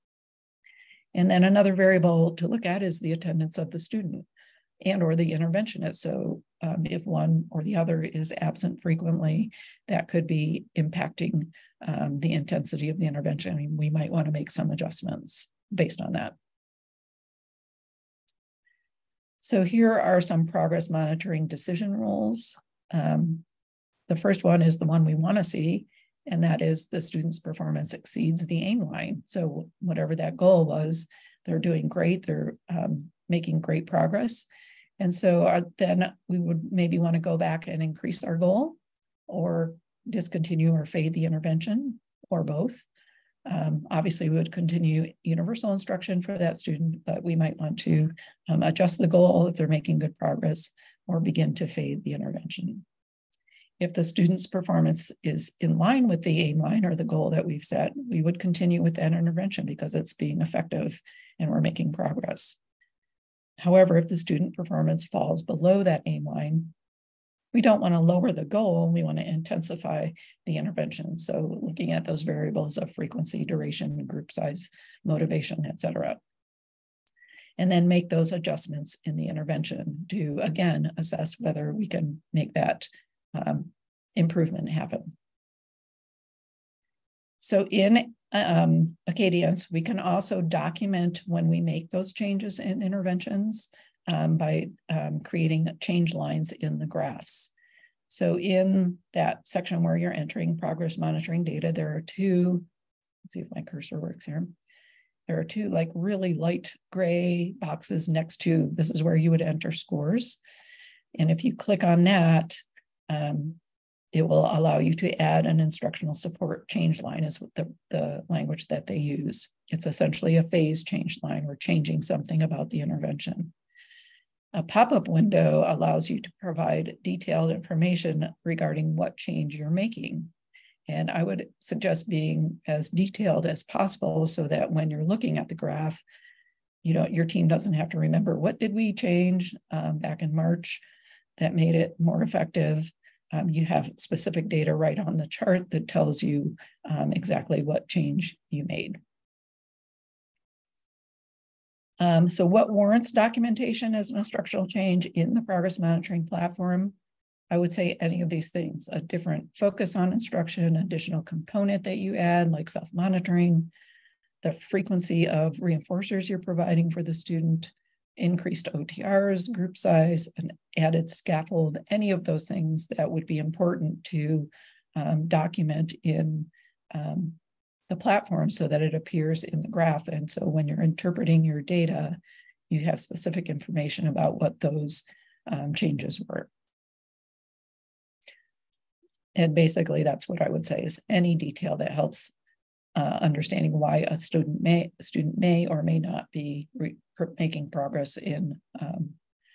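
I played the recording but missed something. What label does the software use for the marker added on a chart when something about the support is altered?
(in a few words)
instructional support change line.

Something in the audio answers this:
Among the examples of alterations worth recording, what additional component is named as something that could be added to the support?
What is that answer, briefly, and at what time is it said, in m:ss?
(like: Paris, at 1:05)
self-monitoring, at 2:42.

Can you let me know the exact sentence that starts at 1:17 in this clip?
And then make those adjustments in the intervention to, again, assess whether we can make that um, improvement happen.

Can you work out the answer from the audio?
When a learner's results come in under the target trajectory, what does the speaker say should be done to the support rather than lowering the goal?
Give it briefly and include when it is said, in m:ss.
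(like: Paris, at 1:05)
intensify the intervention, at 1:09.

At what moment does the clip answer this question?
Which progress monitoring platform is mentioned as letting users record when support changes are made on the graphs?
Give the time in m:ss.
1:29.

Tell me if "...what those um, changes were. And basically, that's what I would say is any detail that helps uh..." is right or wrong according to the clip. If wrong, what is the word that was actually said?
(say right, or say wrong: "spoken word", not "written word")
right.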